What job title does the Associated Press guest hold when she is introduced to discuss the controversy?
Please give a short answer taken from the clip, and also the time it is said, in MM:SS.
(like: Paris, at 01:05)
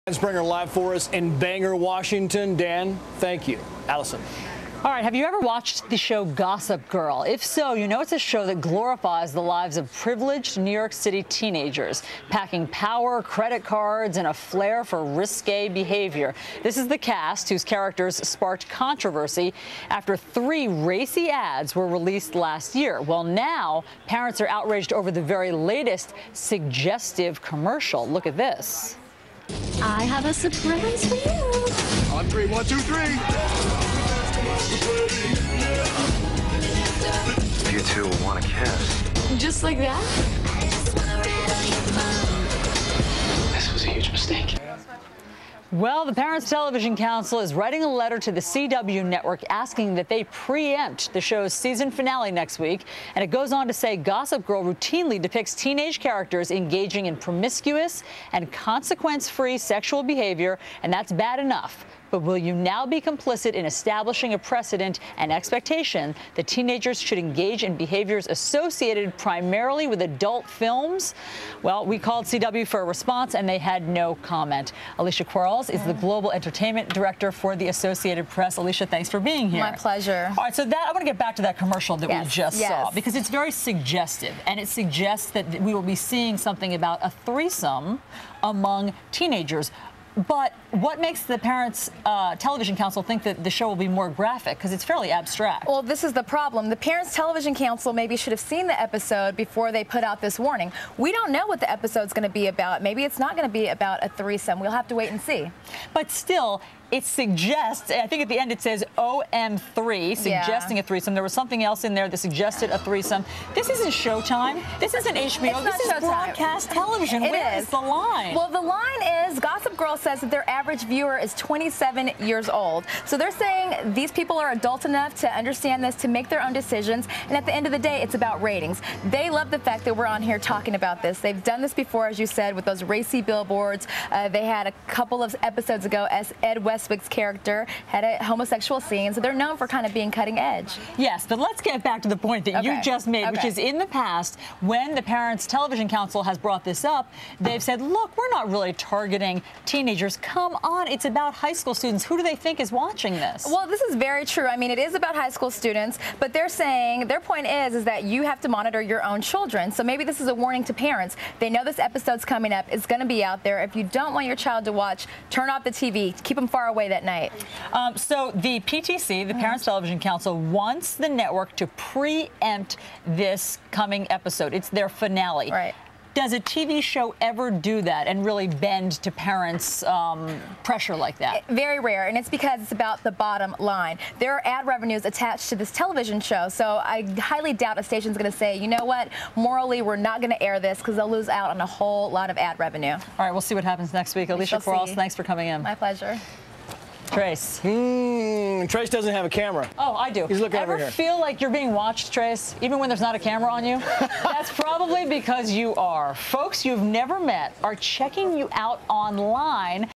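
Global Entertainment Director, at 01:15.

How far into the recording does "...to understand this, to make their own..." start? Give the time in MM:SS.
02:05.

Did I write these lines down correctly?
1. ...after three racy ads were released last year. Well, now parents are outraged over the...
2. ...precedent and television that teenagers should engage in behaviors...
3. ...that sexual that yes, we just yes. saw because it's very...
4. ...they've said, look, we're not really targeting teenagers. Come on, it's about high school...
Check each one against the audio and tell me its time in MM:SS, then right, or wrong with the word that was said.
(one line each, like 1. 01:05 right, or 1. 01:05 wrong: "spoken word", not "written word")
1. 00:19 right
2. 01:04 wrong: "expectation", not "television"
3. 01:21 wrong: "commercial", not "sexual"
4. 02:27 right.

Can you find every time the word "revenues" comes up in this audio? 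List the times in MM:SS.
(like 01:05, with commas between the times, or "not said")
03:04, 03:12.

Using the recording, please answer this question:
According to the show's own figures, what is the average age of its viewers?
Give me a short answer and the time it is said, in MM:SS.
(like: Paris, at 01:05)
27, at 02:01.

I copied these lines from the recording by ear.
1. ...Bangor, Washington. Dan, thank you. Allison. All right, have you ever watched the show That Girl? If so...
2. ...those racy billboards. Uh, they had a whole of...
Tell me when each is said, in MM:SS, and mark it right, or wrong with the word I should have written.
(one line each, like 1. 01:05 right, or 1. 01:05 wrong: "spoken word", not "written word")
1. 00:01 wrong: "Gossip", not "That"
2. 02:12 wrong: "couple", not "whole".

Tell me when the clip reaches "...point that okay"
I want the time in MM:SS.
02:22.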